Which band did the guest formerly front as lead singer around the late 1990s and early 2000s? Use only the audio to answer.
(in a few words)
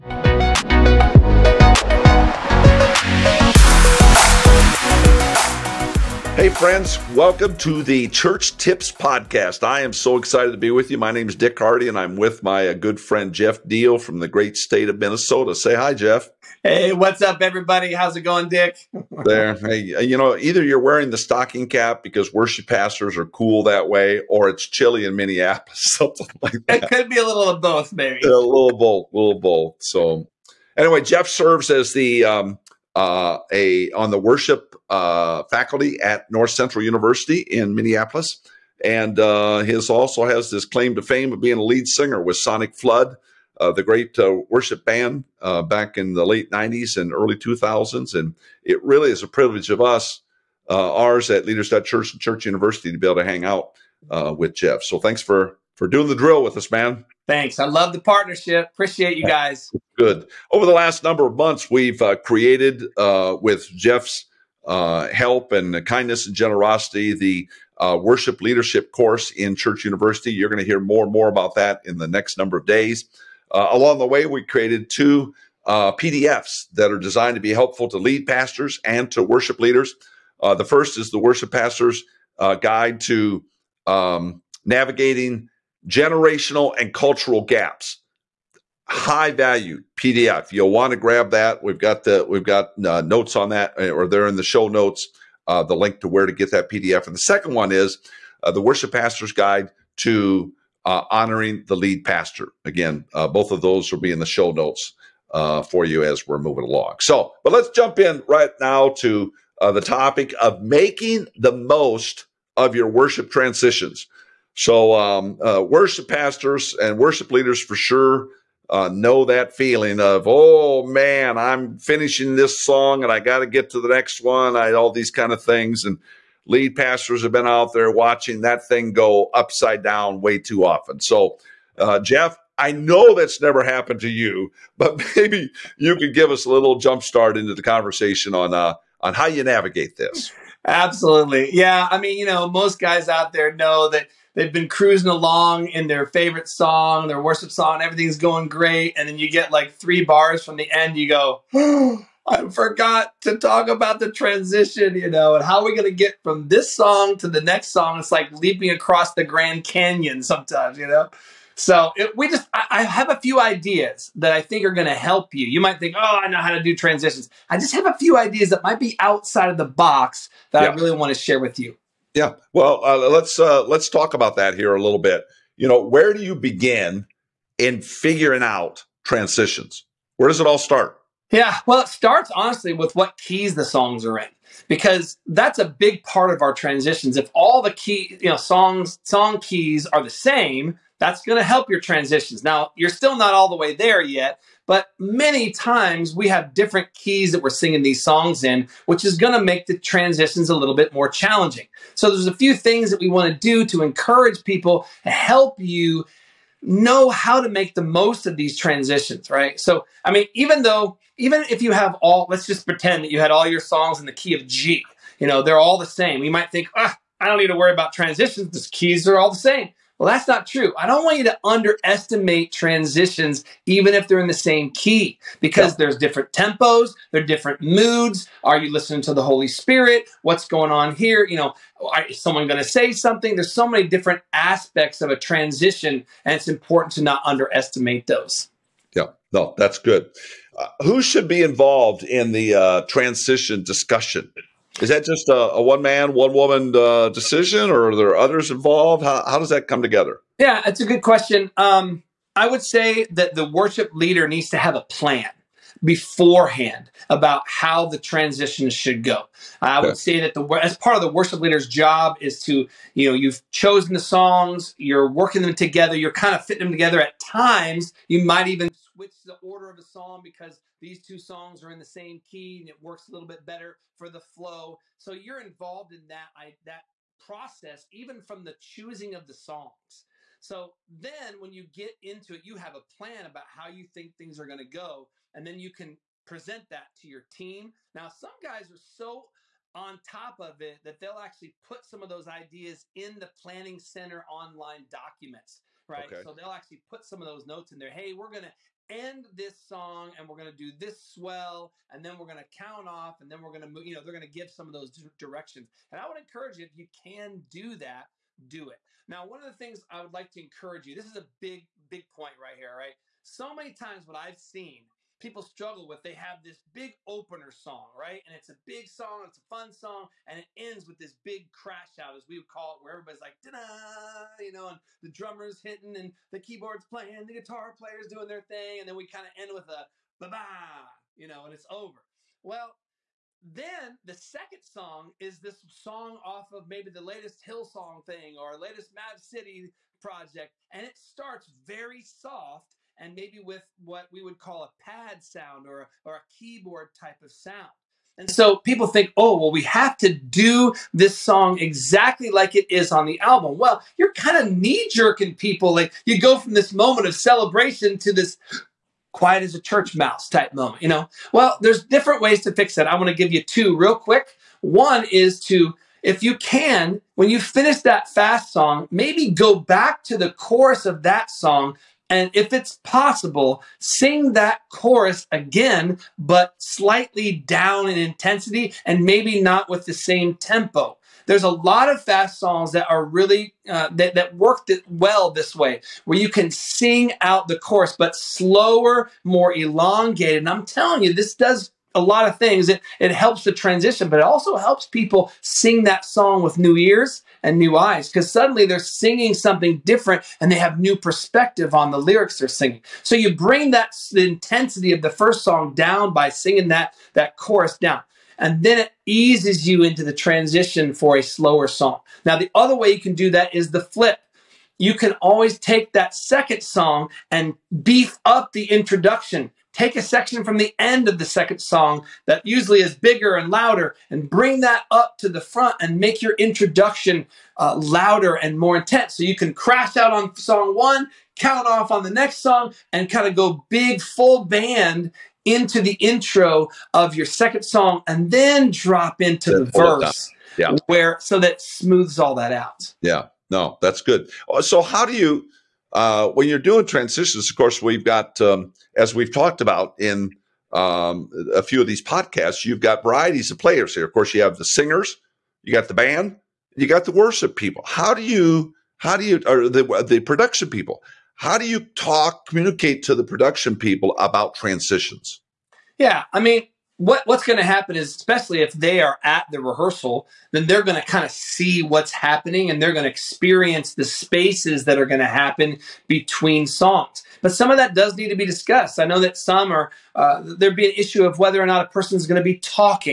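Sonicflood.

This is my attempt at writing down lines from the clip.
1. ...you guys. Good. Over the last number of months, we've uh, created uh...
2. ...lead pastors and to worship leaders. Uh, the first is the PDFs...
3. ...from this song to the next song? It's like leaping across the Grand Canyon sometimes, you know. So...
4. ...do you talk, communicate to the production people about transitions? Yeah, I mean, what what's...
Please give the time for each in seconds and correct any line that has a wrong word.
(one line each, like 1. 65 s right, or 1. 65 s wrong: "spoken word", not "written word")
1. 59 s right
2. 77 s wrong: "Worship", not "PDFs"
3. 156 s right
4. 461 s right.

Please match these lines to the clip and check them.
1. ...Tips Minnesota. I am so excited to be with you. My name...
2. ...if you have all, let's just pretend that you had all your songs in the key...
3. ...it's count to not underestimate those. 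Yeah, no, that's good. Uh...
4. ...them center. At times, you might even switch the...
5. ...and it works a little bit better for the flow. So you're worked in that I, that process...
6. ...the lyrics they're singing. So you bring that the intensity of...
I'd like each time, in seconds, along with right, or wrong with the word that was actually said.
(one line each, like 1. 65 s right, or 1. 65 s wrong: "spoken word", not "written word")
1. 8 s wrong: "Podcast", not "Minnesota"
2. 211 s right
3. 236 s wrong: "important", not "count"
4. 266 s wrong: "together", not "center"
5. 272 s wrong: "involved", not "worked"
6. 401 s right.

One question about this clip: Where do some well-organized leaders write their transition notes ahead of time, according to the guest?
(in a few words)
Planning Center Online.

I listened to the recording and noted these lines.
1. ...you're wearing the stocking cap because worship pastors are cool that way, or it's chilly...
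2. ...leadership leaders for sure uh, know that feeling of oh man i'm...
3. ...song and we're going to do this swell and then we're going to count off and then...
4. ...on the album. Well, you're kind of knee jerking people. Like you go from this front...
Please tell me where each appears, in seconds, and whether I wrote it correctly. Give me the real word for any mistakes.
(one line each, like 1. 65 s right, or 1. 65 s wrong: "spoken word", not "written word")
1. 20 s right
2. 116 s wrong: "worship", not "leadership"
3. 299 s right
4. 352 s wrong: "moment", not "front".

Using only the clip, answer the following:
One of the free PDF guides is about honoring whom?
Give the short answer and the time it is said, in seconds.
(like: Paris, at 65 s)
The lead pastor, at 101 s.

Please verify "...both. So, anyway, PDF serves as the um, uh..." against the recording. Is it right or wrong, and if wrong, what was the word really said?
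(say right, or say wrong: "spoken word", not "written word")
wrong: "Jeff", not "PDF".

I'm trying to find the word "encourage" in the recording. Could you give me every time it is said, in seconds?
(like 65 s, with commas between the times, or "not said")
203 s, 306 s, 310 s.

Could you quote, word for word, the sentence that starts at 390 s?
And I'm telling you, this does a lot of things.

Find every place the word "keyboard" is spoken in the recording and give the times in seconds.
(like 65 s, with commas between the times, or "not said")
326 s, 346 s.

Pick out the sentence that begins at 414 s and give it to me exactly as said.
You can always take that second song and beef up the introduction.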